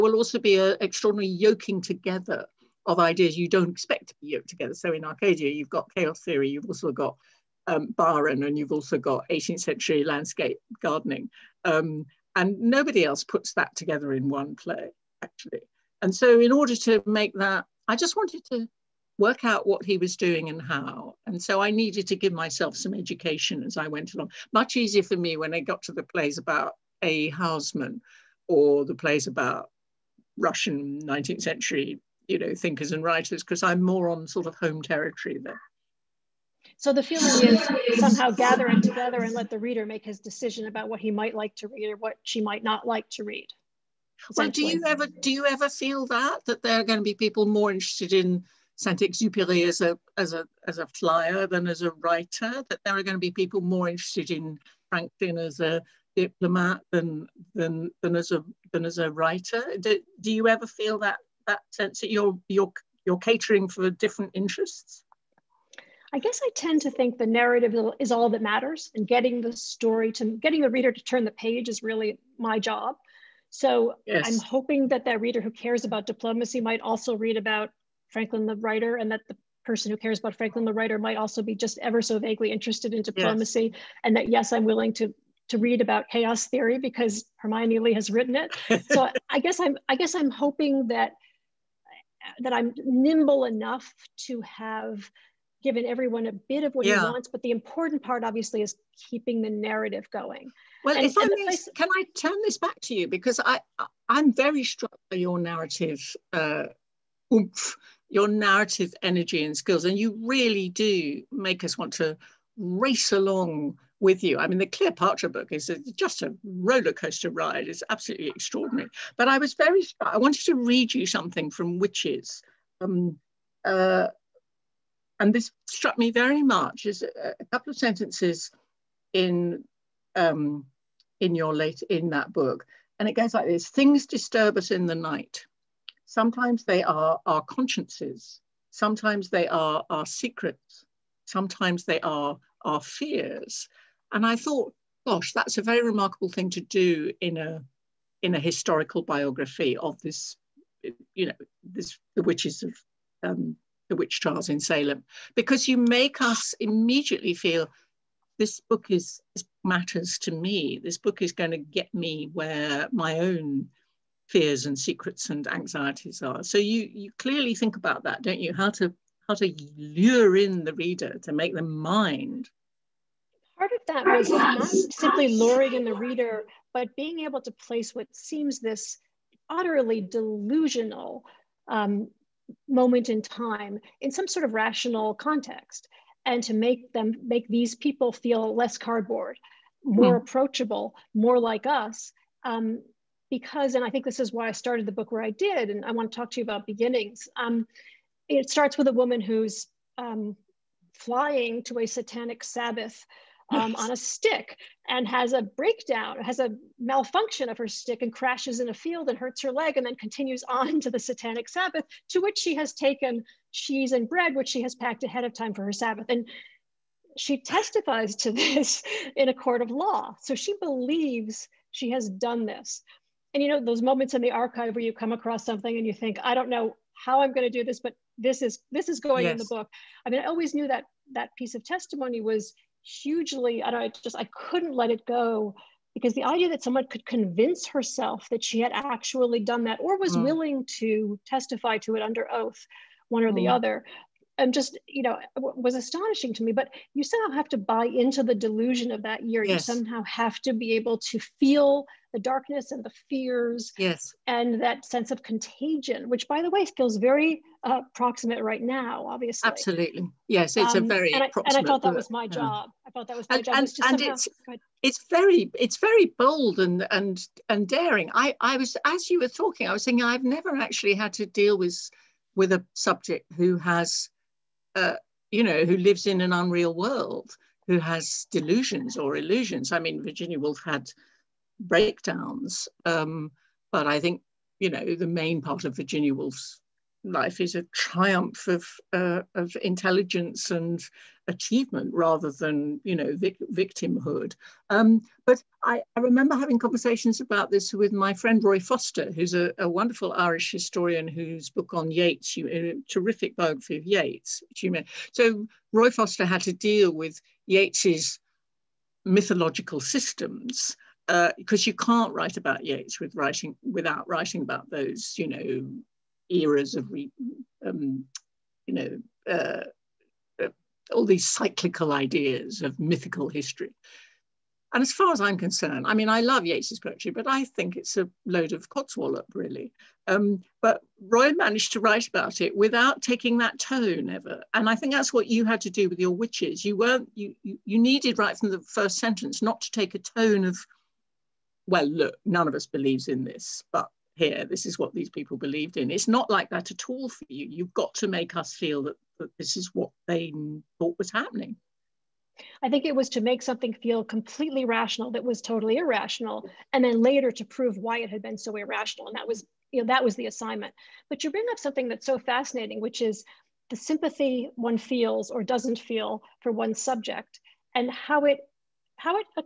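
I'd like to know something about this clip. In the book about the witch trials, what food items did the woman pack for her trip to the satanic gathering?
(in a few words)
cheese and bread.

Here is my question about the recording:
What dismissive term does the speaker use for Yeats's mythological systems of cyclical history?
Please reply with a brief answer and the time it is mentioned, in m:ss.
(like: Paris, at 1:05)
codswallop, at 5:28.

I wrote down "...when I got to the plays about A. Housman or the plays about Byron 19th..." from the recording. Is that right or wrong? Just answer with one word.
wrong.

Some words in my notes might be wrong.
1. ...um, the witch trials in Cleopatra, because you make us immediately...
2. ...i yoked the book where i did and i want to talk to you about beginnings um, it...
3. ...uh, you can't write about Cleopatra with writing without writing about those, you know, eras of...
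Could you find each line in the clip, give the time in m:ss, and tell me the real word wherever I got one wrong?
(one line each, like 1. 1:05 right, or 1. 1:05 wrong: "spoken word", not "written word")
1. 2:33 wrong: "Salem", not "Cleopatra"
2. 3:14 wrong: "started", not "yoked"
3. 5:11 wrong: "Yeats", not "Cleopatra".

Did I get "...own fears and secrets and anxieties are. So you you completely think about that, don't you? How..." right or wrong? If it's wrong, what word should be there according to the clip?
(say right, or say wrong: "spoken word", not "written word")
wrong: "clearly", not "completely".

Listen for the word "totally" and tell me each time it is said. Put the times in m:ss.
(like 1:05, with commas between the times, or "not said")
5:55.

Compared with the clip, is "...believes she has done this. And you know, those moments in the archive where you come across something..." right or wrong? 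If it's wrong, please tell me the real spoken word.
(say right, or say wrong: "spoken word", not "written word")
right.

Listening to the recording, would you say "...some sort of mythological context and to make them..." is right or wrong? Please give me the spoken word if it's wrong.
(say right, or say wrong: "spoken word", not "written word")
wrong: "rational", not "mythological".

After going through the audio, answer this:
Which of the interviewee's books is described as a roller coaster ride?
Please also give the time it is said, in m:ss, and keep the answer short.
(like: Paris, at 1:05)
Cleopatra, at 1:54.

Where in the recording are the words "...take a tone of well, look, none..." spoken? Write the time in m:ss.
5:39.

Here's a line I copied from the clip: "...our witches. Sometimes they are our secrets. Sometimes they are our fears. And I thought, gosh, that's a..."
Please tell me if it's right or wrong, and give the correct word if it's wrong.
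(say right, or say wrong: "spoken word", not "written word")
wrong: "consciences", not "witches".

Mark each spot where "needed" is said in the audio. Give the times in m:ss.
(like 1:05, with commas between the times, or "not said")
0:21, 5:37.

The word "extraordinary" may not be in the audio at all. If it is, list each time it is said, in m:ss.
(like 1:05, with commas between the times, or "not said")
0:00, 1:58.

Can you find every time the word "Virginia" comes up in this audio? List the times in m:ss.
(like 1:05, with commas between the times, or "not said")
4:40, 4:45.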